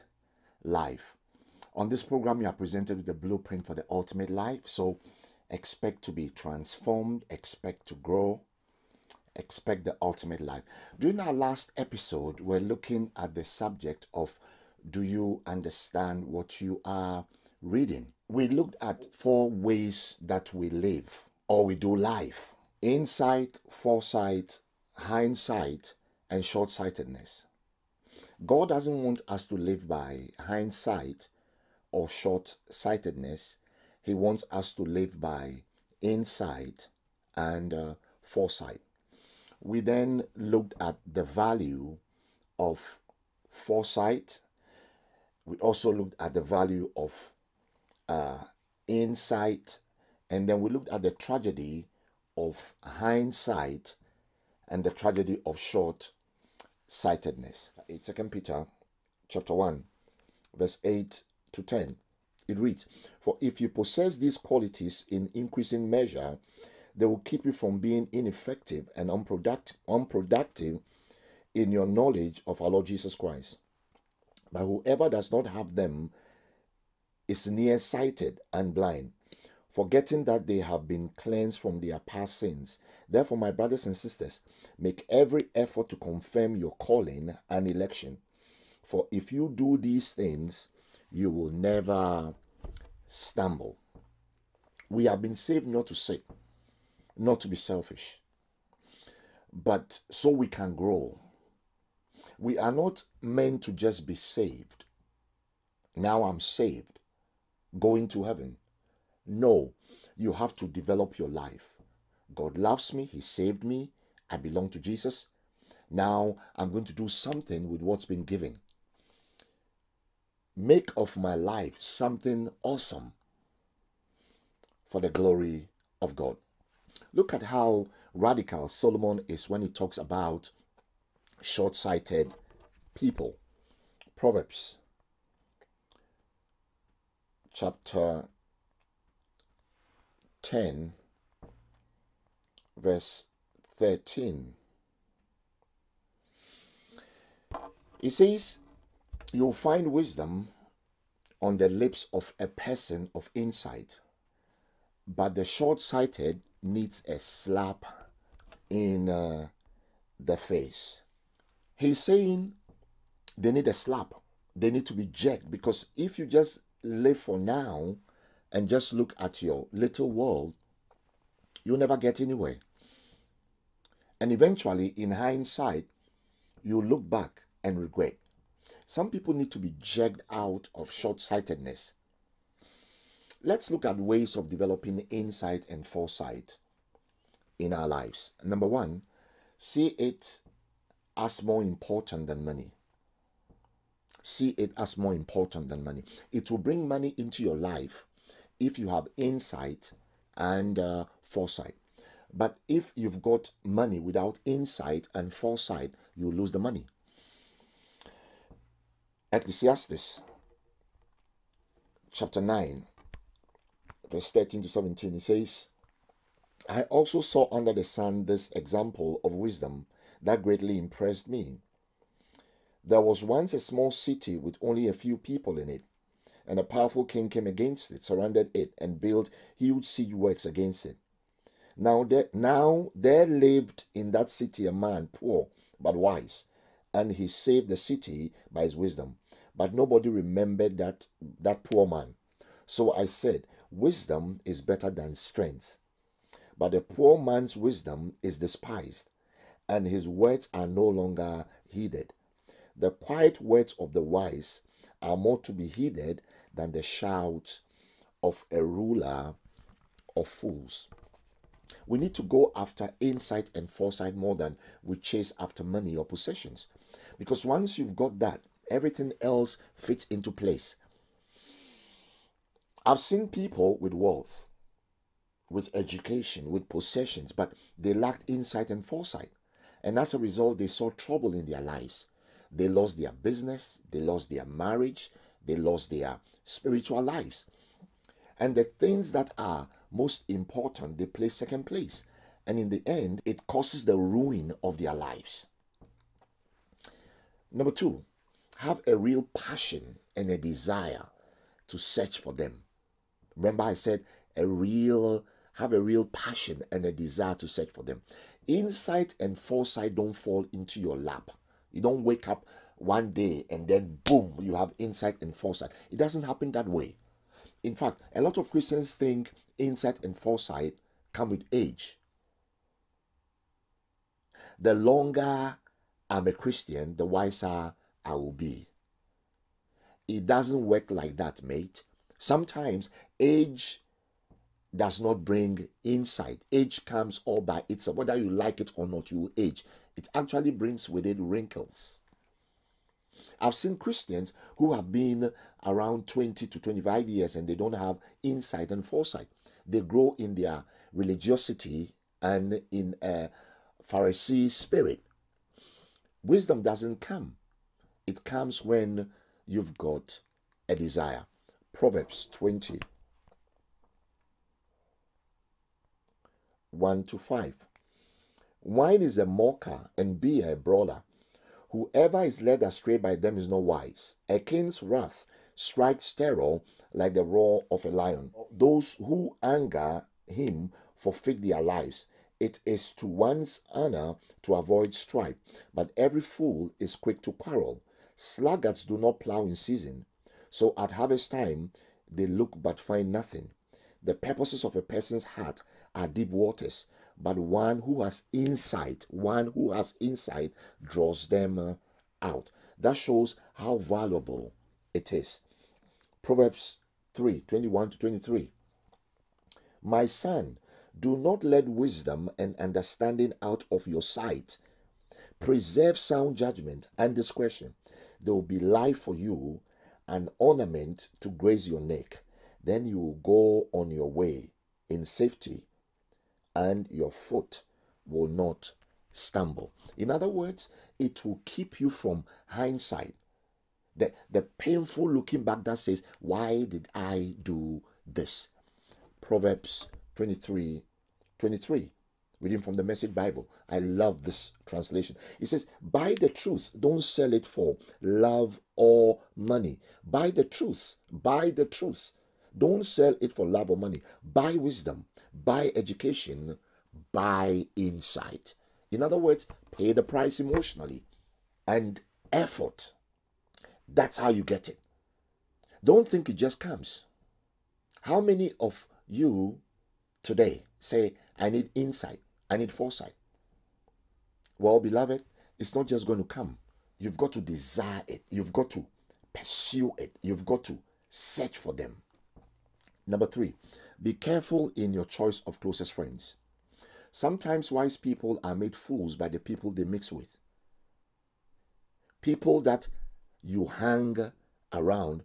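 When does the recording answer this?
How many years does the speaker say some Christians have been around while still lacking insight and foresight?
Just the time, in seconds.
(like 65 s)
346 s.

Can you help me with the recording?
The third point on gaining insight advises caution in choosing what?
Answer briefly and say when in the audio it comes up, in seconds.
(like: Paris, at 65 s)
Closest friends, at 485 s.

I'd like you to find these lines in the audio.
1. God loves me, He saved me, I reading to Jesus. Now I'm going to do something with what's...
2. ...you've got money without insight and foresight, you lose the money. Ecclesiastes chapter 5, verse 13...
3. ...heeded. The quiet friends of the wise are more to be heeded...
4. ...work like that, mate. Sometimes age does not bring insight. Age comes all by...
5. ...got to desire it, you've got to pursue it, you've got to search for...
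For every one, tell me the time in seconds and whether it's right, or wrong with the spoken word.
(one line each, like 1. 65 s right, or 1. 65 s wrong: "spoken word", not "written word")
1. 112 s wrong: "belong", not "reading"
2. 202 s wrong: "9", not "5"
3. 251 s wrong: "words", not "friends"
4. 330 s right
5. 477 s right.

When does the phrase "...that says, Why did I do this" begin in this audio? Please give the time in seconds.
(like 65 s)
435 s.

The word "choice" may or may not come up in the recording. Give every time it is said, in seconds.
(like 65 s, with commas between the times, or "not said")
485 s.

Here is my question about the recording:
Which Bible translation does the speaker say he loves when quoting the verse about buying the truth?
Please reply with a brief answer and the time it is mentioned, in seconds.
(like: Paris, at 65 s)
The Message Bible, at 442 s.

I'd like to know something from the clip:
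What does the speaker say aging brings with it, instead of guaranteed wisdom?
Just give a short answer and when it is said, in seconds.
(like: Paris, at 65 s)
Wrinkles, at 341 s.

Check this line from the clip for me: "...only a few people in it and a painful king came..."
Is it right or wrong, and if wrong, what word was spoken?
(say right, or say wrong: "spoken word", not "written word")
wrong: "powerful", not "painful".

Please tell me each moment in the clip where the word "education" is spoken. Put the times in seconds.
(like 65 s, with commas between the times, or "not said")
275 s, 455 s.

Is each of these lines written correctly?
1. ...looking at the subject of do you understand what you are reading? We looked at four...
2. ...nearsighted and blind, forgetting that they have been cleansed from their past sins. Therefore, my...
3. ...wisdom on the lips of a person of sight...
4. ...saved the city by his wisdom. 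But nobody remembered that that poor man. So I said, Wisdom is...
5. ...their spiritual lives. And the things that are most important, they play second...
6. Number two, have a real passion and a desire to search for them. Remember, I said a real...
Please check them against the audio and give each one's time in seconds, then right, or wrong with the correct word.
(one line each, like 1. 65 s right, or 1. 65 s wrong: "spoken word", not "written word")
1. 12 s right
2. 77 s right
3. 149 s wrong: "insight", not "sight"
4. 237 s right
5. 285 s right
6. 297 s right.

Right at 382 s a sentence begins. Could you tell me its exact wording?
It is to one's honor to avoid strife, but every fool is quick to quarrel.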